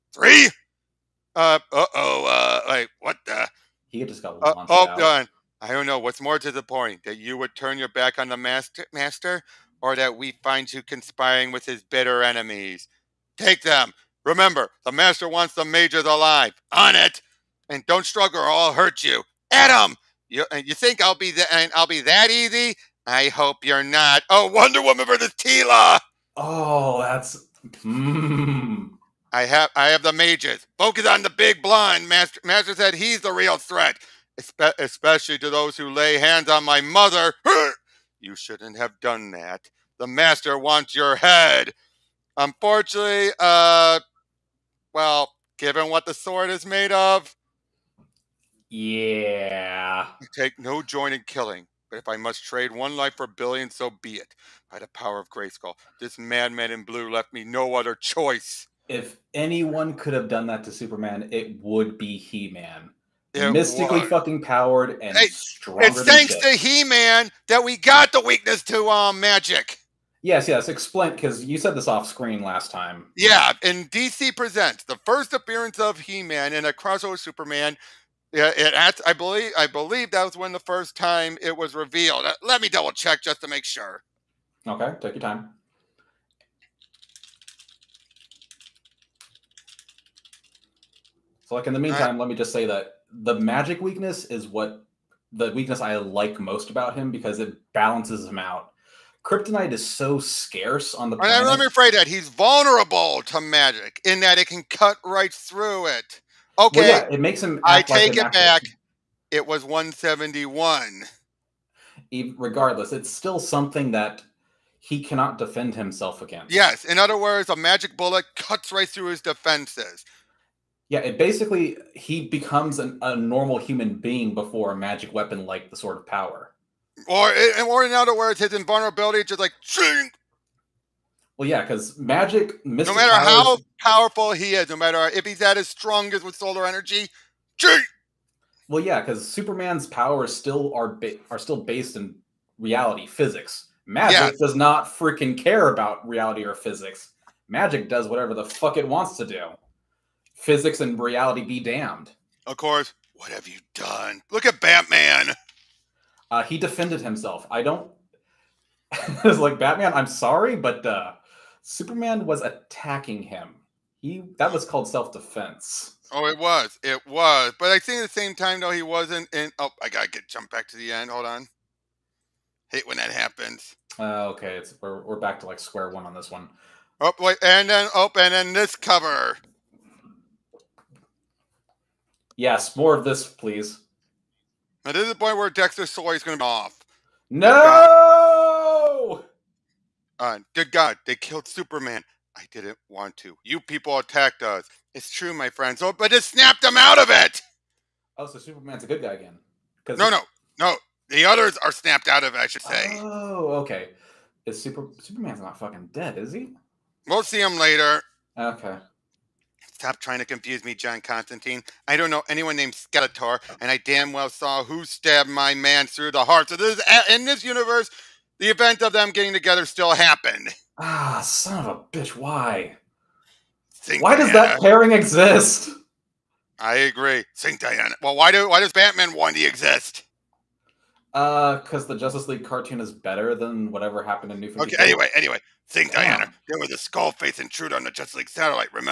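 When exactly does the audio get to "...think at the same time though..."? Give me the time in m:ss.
2:47.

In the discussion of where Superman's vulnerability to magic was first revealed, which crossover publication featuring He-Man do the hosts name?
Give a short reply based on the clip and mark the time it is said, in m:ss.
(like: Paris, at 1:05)
DC Presents, at 1:13.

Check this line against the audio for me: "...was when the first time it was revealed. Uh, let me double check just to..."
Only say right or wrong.
right.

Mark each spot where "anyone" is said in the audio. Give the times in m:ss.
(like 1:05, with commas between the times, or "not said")
0:59, 3:32.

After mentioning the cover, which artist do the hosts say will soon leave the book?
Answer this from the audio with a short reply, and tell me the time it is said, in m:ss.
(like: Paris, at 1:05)
Dexter Soy, at 3:05.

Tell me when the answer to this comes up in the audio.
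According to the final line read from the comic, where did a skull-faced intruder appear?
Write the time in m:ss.
3:57.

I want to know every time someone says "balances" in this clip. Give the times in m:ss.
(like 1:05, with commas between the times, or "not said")
1:37.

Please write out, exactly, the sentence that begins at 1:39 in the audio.
Kryptonite is so scarce on the.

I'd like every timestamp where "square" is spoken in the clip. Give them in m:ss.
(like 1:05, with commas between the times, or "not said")
2:55.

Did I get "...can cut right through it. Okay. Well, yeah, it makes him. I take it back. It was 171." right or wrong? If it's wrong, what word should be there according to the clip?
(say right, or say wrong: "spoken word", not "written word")
right.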